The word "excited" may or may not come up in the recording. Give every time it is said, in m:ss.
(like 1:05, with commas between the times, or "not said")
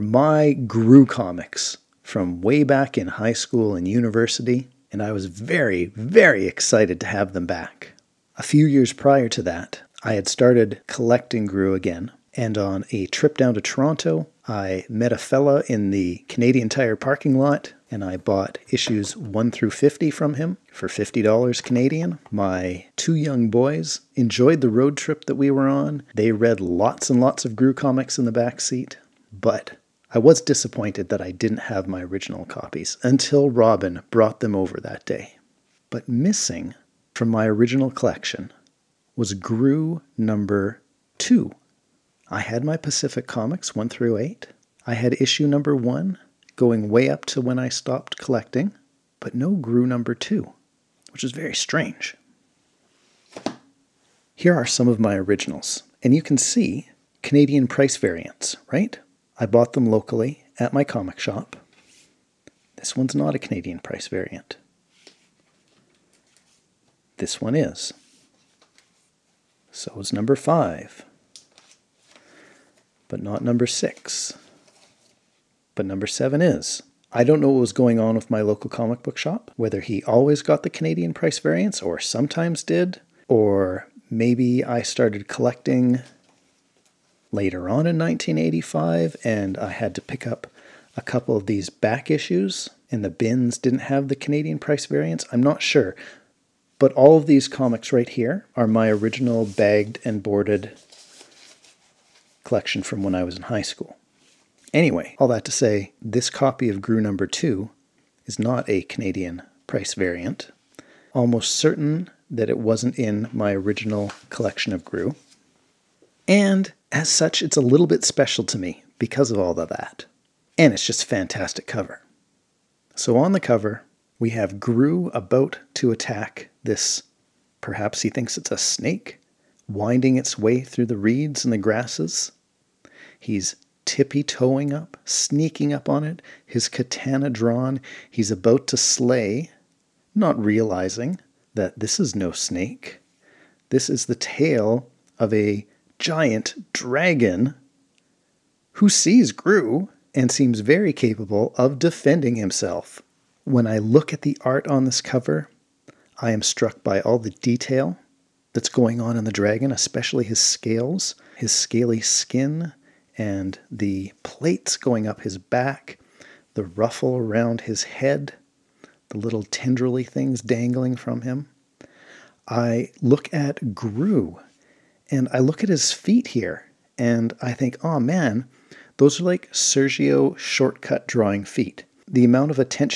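0:06.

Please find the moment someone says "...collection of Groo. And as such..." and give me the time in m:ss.
1:54.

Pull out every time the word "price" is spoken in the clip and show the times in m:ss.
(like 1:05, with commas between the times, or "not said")
0:57, 1:03, 1:21, 1:34, 1:49.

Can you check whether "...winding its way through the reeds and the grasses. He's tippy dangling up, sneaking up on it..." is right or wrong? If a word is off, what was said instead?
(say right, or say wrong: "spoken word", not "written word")
wrong: "toeing", not "dangling".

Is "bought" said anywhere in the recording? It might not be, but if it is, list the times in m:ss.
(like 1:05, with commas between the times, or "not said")
0:18, 0:59.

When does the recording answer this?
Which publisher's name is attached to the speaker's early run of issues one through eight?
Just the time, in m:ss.
0:42.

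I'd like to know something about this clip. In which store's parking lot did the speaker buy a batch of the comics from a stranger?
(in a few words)
Canadian Tire.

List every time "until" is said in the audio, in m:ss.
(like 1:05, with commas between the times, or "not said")
0:33.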